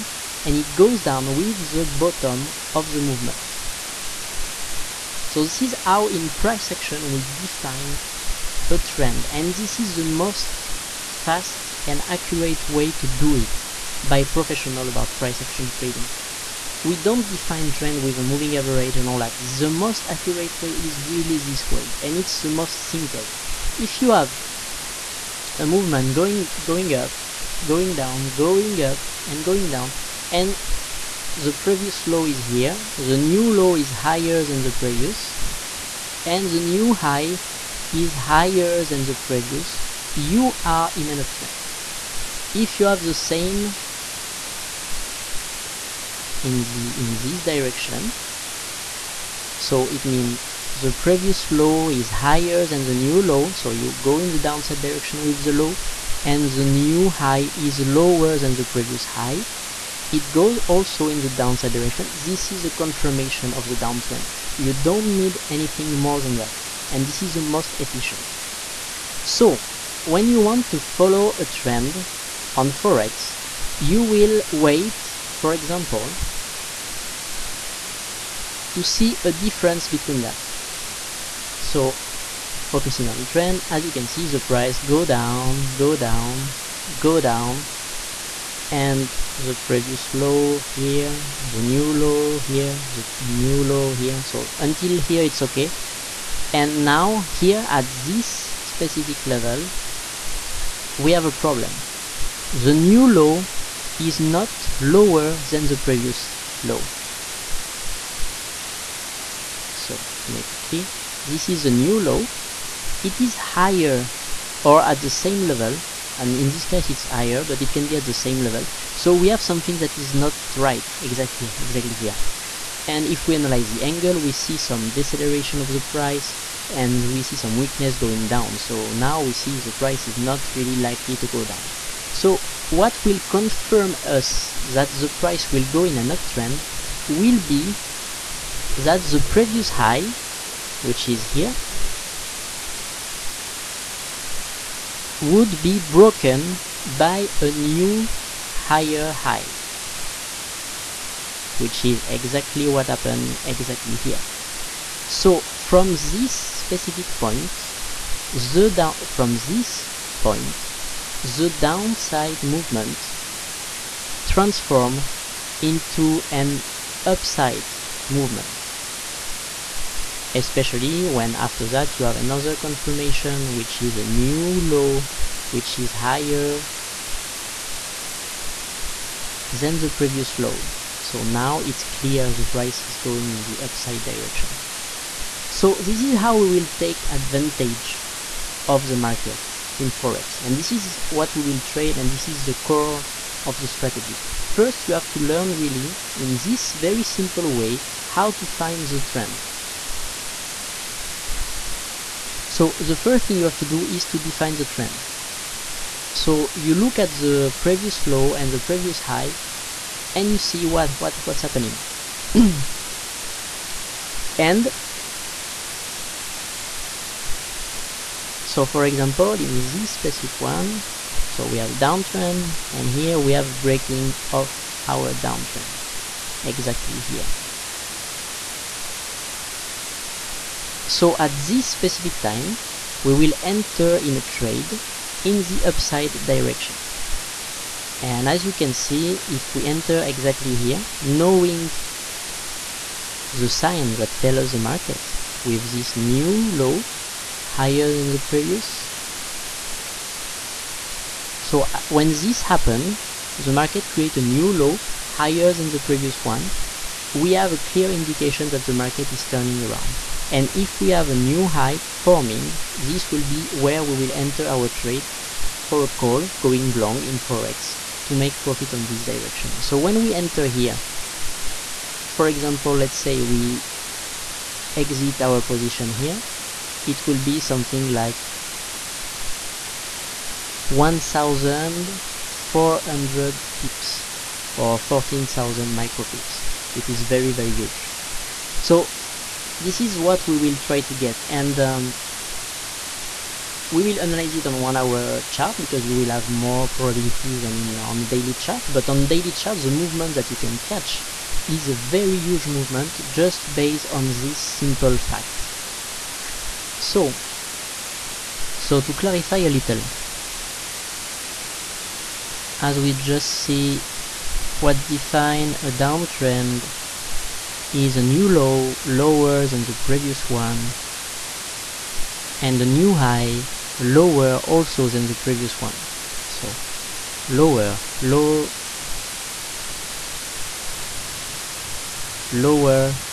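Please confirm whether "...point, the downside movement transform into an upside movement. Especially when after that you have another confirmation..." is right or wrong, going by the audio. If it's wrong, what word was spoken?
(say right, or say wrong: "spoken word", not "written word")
right.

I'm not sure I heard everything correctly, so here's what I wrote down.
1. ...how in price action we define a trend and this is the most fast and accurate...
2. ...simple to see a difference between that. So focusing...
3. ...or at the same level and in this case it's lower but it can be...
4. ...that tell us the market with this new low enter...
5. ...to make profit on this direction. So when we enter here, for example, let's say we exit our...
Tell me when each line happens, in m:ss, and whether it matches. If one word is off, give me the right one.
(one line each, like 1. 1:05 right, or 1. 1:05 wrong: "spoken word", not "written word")
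1. 0:05 right
2. 1:15 wrong: "example", not "simple"
3. 1:54 wrong: "higher", not "lower"
4. 4:03 wrong: "higher", not "enter"
5. 4:28 right.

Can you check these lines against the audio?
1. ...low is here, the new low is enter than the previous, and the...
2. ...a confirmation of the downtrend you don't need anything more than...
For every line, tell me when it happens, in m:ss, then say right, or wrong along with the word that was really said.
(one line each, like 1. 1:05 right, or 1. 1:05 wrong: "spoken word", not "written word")
1. 0:32 wrong: "higher", not "enter"
2. 1:02 right.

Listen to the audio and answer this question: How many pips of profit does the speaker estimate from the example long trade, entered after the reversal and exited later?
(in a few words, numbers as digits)
1,400 pips.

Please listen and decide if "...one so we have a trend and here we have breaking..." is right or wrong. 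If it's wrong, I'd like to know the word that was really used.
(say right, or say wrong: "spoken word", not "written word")
wrong: "downtrend", not "trend".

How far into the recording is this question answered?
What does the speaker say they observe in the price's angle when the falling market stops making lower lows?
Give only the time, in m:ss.
2:04.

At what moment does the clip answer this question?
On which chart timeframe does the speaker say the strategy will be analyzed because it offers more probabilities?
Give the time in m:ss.
4:54.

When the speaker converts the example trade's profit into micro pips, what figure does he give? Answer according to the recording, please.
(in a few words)
14,000 micro pips.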